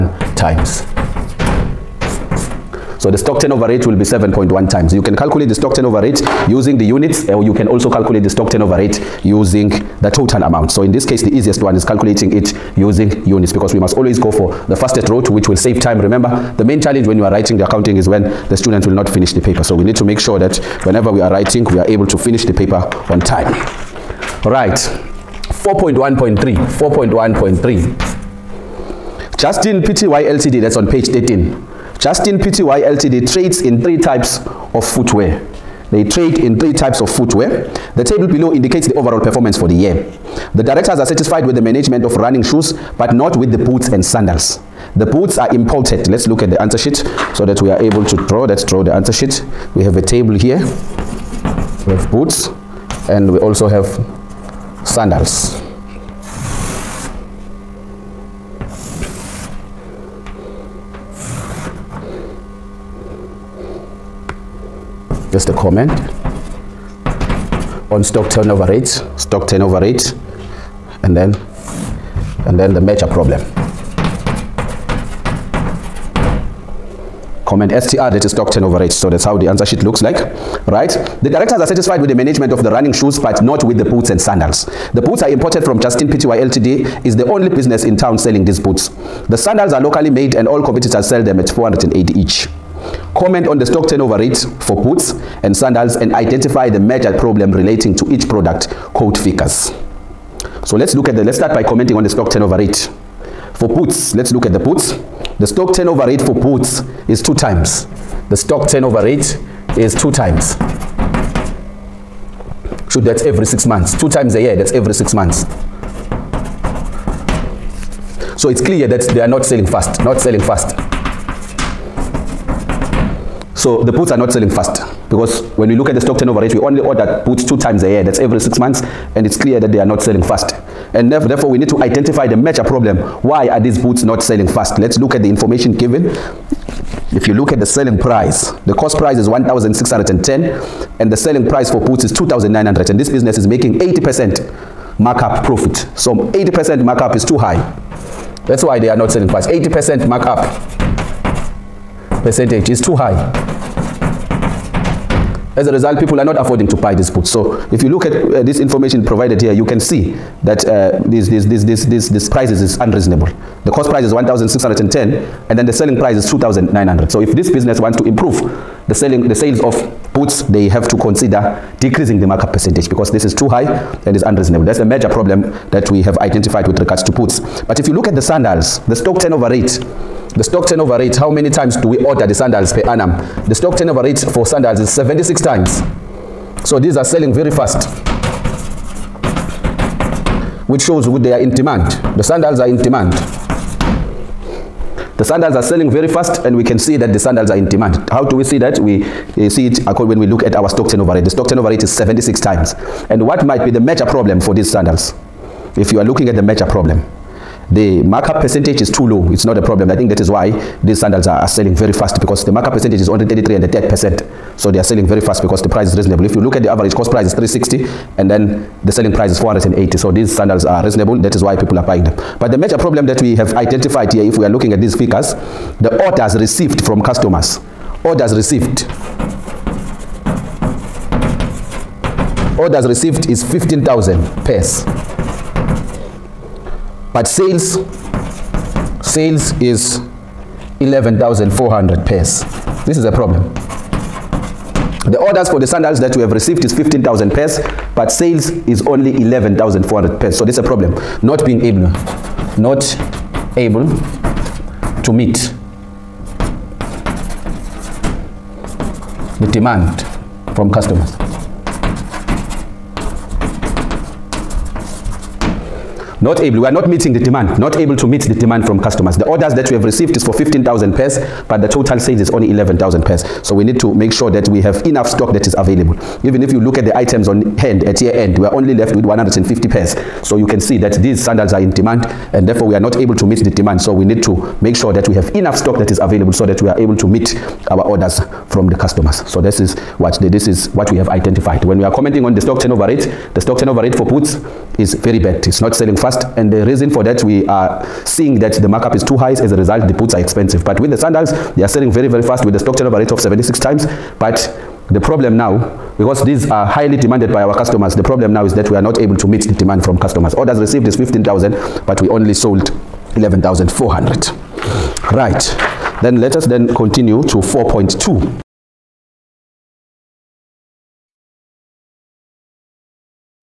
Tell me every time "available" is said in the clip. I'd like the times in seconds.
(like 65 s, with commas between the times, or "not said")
275 s, 285 s.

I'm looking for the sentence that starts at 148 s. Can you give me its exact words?
That's why they are not selling price.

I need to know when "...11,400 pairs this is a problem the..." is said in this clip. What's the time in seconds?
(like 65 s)
240 s.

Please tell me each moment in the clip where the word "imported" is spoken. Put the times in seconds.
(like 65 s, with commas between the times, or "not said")
45 s, 85 s.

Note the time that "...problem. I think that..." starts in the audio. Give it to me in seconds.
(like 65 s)
209 s.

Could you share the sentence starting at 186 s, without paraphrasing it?
So these are selling very fast.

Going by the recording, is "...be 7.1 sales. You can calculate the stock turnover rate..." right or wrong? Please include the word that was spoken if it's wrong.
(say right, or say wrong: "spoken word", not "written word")
wrong: "times", not "sales".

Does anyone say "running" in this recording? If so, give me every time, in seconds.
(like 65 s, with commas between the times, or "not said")
42 s, 82 s.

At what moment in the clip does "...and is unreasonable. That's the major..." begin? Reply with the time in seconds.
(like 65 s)
174 s.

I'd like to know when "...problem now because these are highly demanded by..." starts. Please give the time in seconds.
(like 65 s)
304 s.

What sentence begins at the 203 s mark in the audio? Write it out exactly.
And what might be the major problem for these sandals?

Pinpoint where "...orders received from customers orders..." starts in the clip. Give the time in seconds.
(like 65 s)
226 s.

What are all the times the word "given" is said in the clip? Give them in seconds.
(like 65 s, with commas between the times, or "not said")
135 s.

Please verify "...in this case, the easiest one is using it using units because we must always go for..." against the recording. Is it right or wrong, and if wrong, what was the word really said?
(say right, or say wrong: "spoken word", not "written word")
wrong: "calculating", not "using".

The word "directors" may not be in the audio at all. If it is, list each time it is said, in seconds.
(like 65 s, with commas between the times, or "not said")
40 s, 81 s.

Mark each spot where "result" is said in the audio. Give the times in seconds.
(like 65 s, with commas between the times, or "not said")
155 s, 299 s.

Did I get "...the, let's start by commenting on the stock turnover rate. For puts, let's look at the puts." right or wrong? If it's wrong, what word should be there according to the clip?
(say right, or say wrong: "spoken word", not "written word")
right.